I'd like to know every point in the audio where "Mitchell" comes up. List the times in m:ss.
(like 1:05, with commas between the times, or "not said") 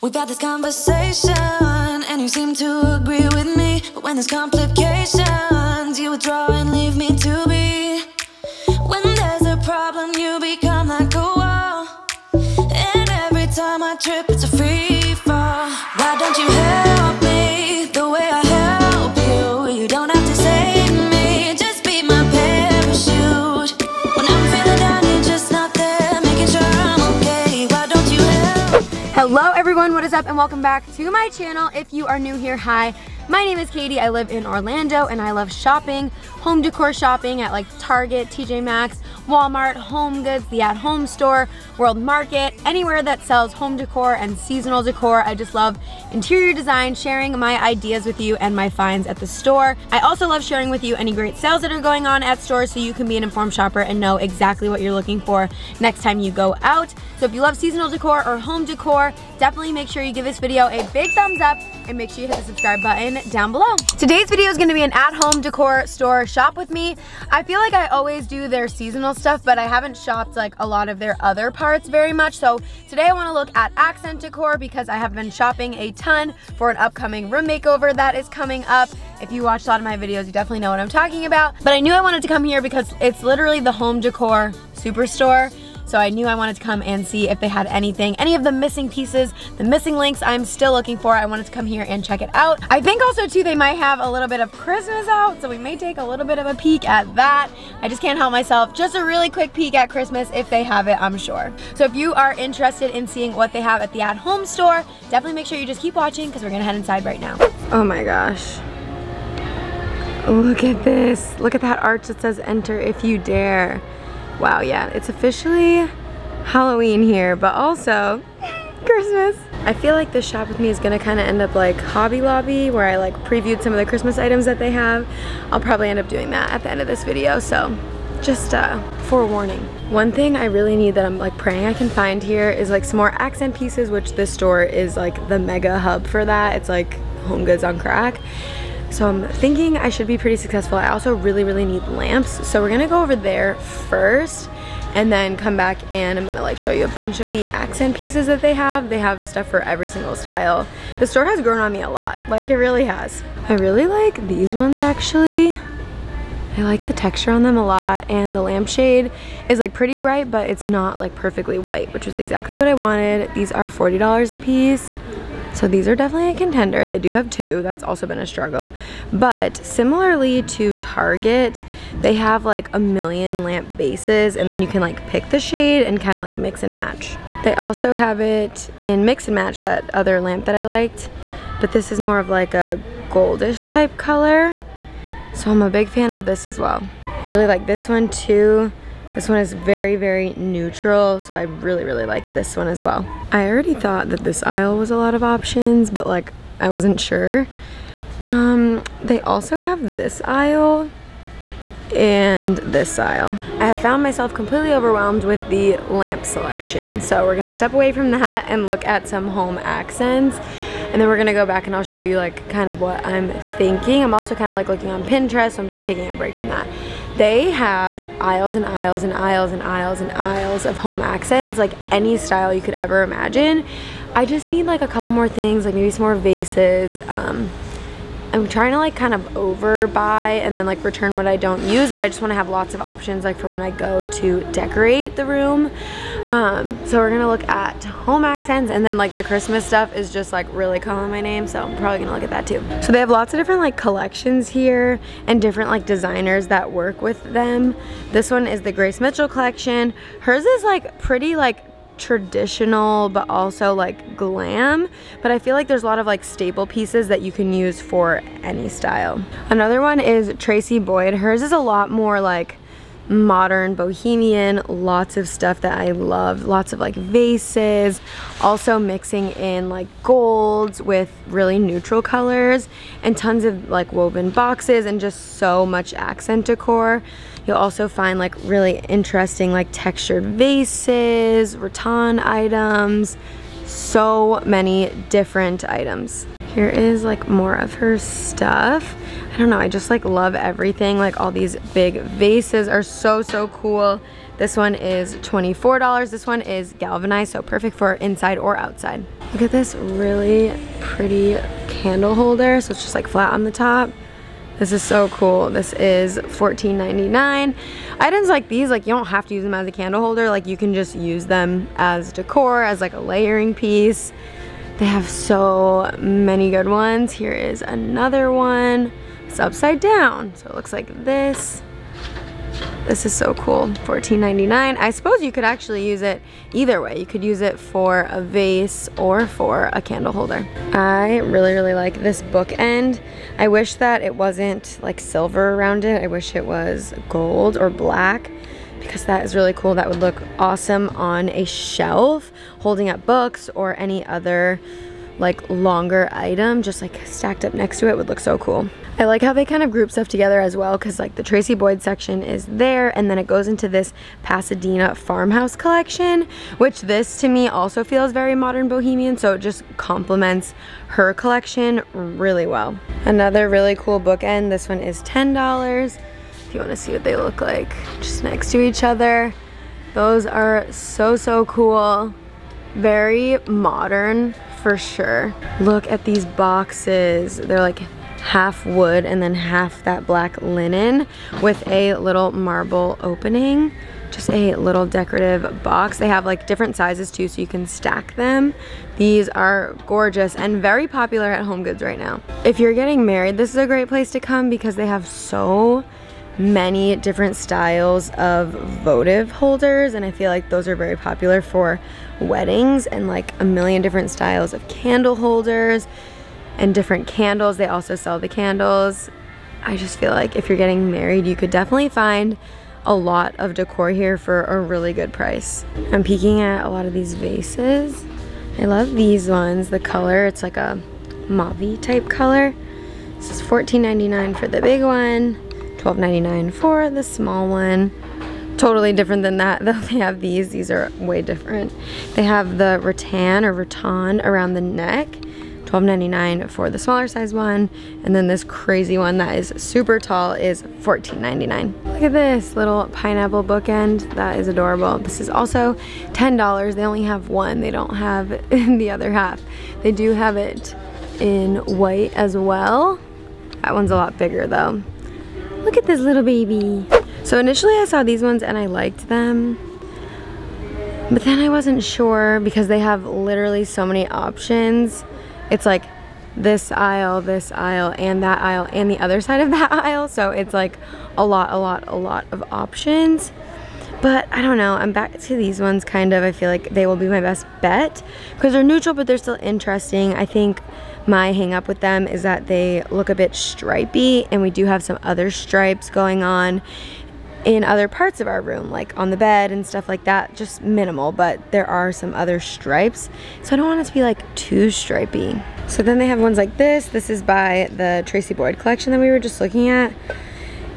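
4:08.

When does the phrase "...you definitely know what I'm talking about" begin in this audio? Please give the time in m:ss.
1:20.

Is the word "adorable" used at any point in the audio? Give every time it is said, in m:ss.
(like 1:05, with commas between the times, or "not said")
7:24.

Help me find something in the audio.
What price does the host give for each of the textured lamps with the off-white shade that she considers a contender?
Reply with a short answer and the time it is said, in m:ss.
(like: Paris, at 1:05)
$40, at 2:43.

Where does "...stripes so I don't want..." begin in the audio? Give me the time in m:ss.
8:12.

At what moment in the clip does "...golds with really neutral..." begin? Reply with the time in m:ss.
4:30.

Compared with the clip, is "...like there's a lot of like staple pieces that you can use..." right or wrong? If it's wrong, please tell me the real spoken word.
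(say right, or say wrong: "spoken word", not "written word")
right.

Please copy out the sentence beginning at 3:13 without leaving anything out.
I already thought that this aisle was a lot of options, but like, I wasn't sure.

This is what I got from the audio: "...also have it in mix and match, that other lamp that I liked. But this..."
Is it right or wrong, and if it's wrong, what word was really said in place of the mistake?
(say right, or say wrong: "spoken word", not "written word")
right.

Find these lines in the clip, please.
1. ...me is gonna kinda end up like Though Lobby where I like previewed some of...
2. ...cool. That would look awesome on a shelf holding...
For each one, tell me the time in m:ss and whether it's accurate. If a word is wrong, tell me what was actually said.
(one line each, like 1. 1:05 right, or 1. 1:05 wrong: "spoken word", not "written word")
1. 2:00 wrong: "Hobby", not "Though"
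2. 5:39 right.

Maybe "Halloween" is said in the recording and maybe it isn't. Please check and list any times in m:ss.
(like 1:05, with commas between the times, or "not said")
1:56.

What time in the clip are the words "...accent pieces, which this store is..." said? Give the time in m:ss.
2:13.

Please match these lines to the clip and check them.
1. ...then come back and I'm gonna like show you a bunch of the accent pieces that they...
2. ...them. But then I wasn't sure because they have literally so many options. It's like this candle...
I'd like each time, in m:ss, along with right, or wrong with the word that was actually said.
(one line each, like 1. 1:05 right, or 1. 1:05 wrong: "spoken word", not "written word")
1. 2:25 right
2. 7:39 wrong: "aisle", not "candle".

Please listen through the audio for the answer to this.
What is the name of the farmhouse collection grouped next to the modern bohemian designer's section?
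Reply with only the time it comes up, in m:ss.
5:54.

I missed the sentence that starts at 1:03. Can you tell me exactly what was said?
Today's video is gonna be an at-home decor store shop with me.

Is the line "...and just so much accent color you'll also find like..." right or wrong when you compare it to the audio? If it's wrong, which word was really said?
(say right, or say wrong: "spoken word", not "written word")
wrong: "decor", not "color".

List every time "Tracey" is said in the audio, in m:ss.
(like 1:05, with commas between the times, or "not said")
4:20, 5:51, 8:18.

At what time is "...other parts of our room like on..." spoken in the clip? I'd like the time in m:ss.
8:07.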